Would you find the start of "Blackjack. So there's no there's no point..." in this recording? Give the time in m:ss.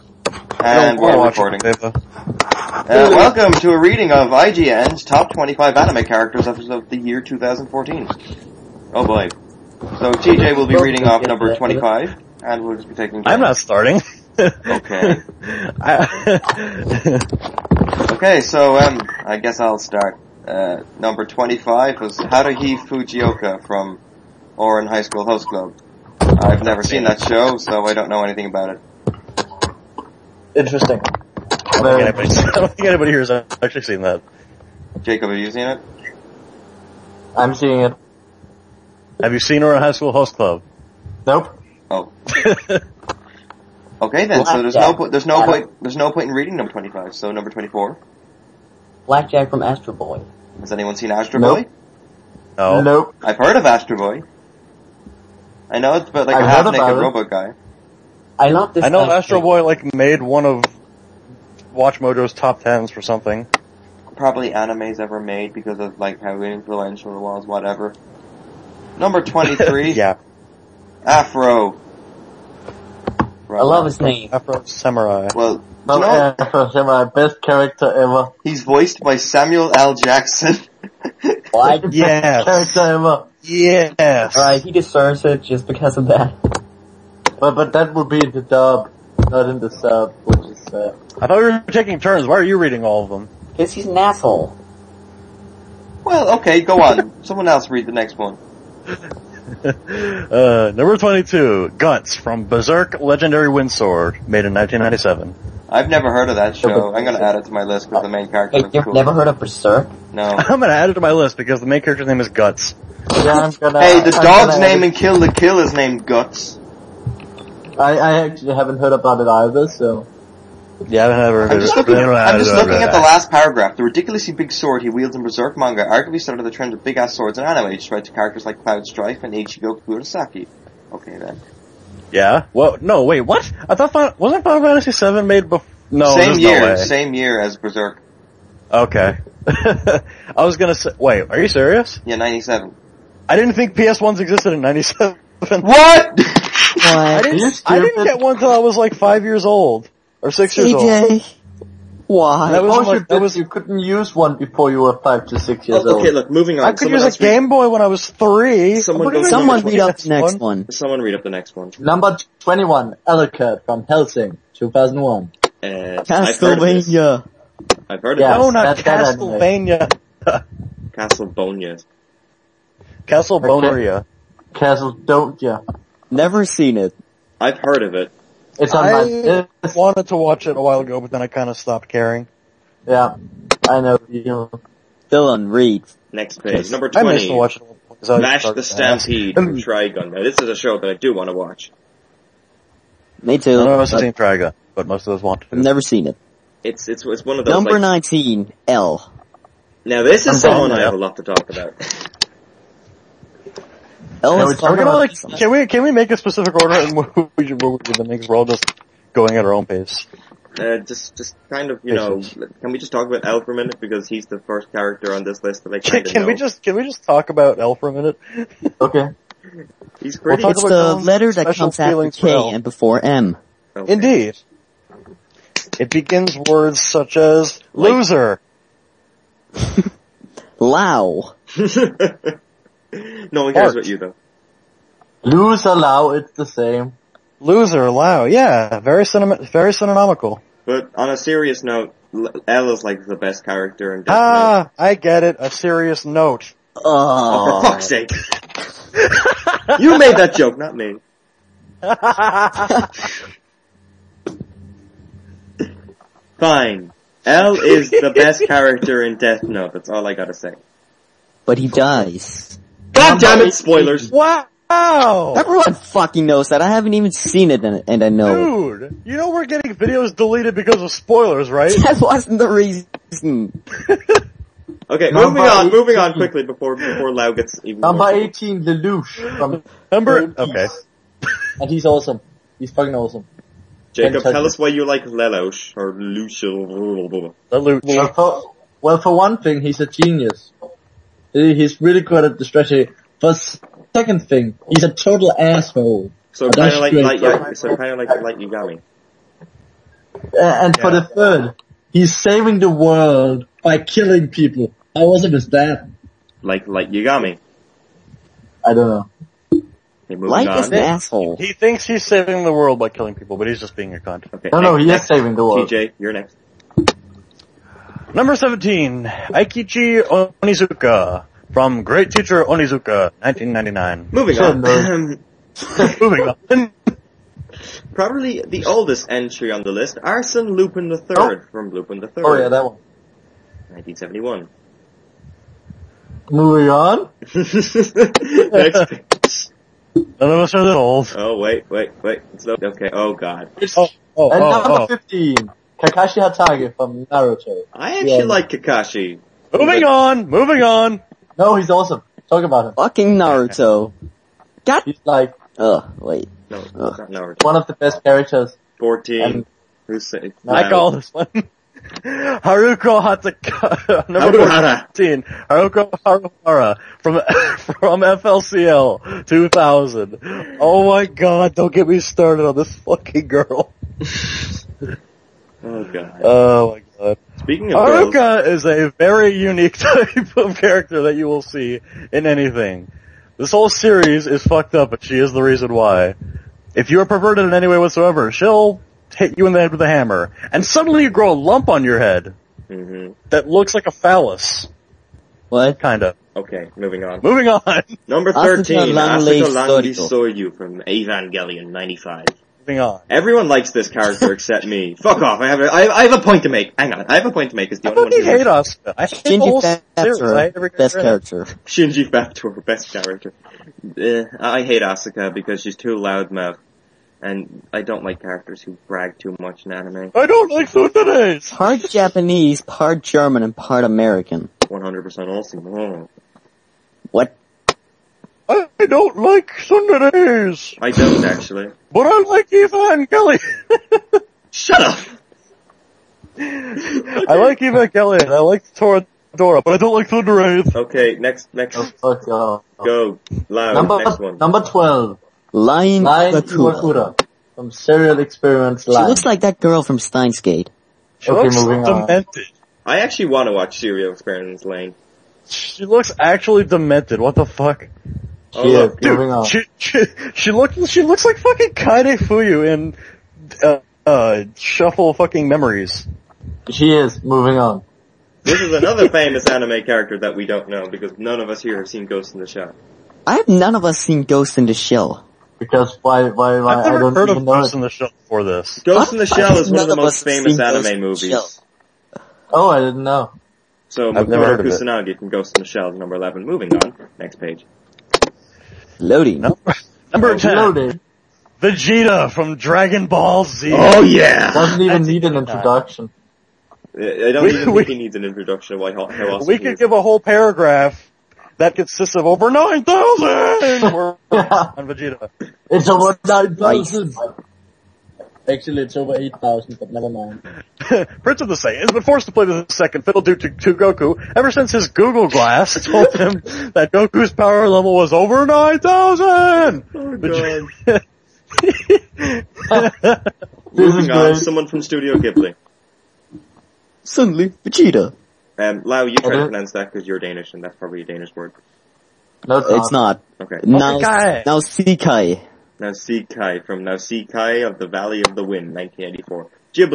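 0:43.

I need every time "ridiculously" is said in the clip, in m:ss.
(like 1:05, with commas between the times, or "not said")
2:03.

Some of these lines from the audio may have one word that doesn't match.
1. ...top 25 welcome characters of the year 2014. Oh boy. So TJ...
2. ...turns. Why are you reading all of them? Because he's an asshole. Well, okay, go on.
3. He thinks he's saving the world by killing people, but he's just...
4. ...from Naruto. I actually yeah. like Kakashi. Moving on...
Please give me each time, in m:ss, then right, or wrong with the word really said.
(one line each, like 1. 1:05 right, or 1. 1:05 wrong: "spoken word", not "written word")
1. 0:05 wrong: "anime", not "welcome"
2. 1:31 right
3. 5:11 right
4. 5:46 right.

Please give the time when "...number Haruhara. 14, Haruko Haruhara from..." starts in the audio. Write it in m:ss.
6:04.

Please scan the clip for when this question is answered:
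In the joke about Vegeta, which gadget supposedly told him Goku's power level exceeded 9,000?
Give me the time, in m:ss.
8:34.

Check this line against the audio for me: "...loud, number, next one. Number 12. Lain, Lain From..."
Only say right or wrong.
right.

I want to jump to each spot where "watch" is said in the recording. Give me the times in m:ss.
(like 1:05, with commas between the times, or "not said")
1:01, 3:00, 3:07, 3:11, 7:33.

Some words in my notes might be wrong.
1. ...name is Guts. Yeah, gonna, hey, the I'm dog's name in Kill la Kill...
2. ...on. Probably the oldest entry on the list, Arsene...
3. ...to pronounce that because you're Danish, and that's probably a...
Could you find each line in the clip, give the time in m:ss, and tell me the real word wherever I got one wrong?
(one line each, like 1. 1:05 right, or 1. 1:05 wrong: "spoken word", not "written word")
1. 1:52 right
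2. 5:26 right
3. 8:49 right.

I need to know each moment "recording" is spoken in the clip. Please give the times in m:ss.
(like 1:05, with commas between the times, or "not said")
0:01.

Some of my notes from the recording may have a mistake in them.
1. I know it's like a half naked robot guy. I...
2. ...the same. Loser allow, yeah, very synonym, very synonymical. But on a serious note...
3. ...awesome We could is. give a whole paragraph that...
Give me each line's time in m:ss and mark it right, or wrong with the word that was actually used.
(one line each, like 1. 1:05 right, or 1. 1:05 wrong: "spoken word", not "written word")
1. 0:55 right
2. 3:56 right
3. 8:19 right.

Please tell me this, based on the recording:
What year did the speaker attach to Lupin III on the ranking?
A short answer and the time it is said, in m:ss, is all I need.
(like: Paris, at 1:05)
1971, at 5:33.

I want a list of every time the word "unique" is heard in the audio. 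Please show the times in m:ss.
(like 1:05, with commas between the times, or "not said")
6:19.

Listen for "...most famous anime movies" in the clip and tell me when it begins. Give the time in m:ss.
7:59.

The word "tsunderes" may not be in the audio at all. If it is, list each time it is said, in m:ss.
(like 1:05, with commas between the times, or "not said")
7:00, 7:09.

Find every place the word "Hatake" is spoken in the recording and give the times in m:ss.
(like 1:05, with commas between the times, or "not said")
5:46, 6:02.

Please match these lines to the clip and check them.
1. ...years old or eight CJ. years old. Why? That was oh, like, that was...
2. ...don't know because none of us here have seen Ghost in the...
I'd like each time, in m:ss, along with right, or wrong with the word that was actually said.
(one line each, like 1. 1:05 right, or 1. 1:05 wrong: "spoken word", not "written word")
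1. 2:29 wrong: "six", not "eight"
2. 7:50 right.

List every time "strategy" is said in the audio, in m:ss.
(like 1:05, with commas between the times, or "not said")
4:52.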